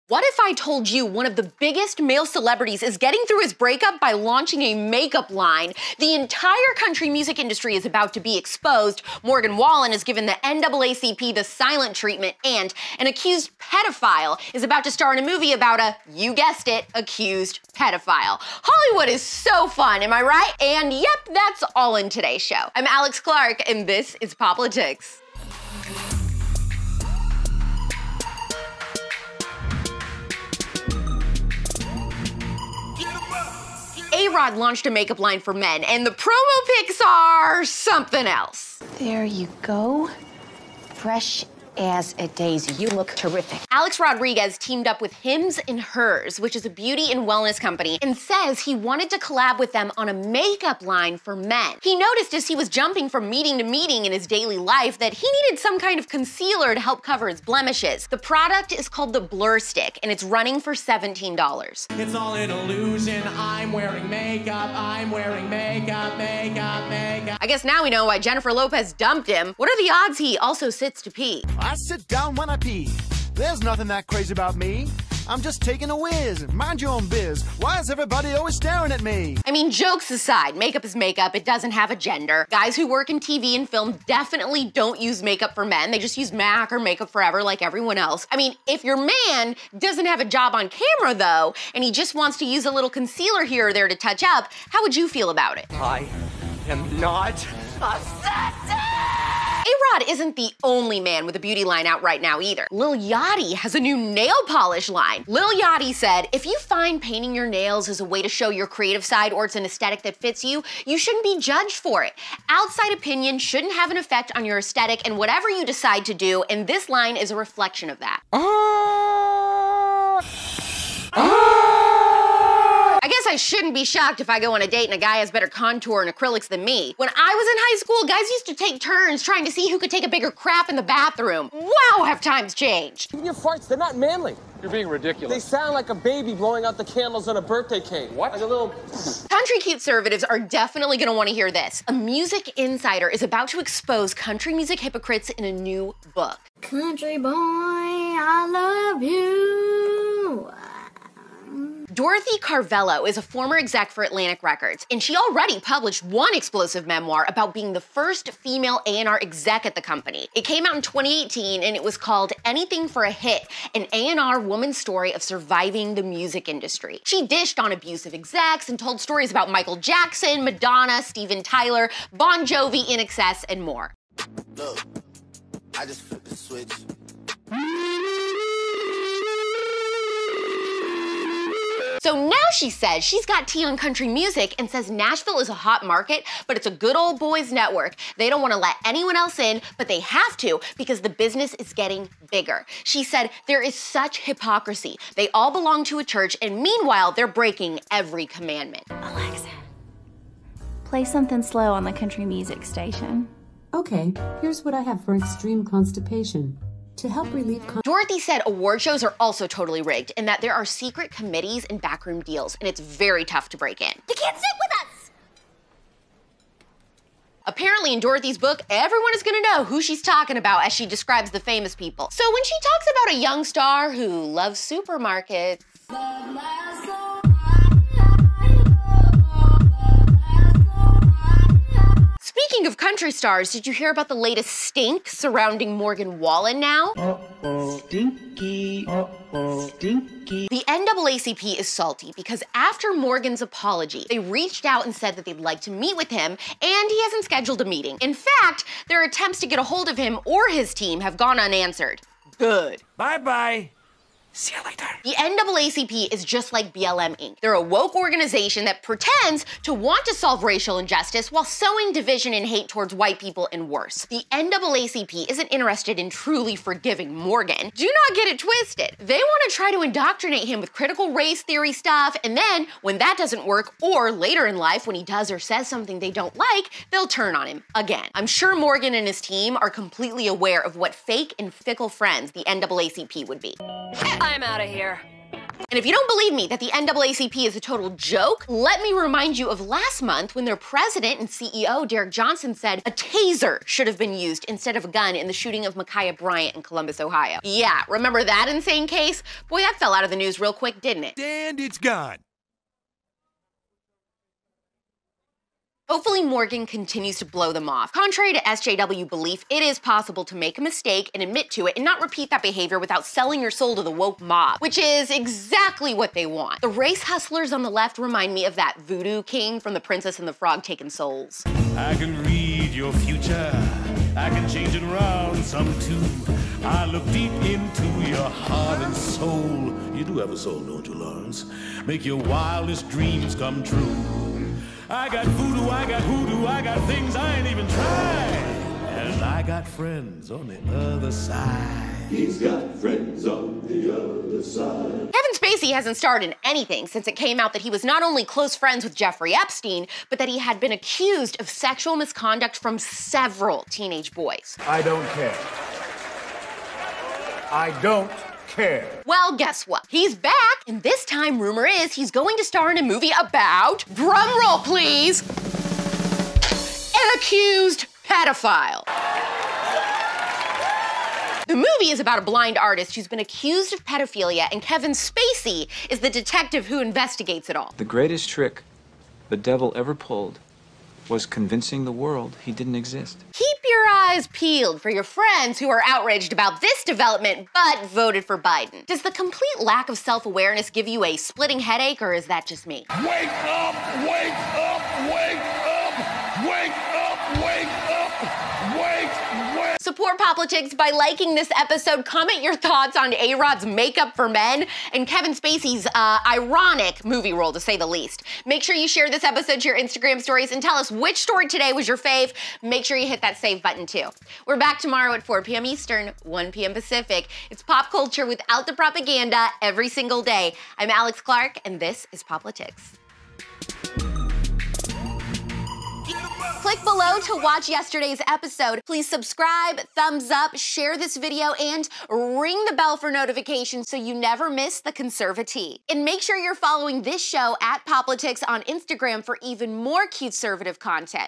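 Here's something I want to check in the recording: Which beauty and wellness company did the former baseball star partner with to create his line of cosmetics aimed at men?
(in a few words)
Hims and Hers.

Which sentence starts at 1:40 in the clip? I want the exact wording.
isn't the only man with a beauty line out right now either.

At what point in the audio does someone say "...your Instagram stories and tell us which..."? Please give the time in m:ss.
6:49.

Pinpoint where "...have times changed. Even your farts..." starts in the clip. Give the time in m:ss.
2:12.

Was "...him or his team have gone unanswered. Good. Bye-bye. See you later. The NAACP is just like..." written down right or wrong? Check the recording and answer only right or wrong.
right.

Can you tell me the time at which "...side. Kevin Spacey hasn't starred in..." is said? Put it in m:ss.
5:44.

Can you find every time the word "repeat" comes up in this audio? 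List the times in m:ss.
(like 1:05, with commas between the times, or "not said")
5:12.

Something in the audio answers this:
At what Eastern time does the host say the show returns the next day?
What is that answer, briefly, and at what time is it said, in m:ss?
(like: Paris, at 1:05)
4 p.m. Eastern, at 6:55.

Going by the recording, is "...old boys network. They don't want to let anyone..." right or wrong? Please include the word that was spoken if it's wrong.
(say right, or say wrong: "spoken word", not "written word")
right.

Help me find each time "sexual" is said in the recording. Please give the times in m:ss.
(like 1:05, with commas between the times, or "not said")
5:51.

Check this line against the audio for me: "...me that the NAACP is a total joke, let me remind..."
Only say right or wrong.
right.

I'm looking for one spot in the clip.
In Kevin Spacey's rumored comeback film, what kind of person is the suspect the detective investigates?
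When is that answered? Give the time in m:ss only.
6:12.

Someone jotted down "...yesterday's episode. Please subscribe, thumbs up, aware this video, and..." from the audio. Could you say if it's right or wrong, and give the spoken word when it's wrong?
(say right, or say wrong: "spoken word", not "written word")
wrong: "share", not "aware".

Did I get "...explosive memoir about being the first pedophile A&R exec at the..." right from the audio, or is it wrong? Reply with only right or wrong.
wrong.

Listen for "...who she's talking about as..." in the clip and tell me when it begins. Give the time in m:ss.
3:39.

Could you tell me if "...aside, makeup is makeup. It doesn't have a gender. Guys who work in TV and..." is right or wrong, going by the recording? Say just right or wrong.
right.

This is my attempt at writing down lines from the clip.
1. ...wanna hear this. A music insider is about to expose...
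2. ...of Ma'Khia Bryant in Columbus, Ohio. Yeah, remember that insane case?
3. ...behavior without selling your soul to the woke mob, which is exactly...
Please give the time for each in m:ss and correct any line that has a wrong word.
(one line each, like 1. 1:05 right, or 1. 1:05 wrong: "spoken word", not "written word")
1. 2:21 right
2. 4:55 right
3. 5:12 right.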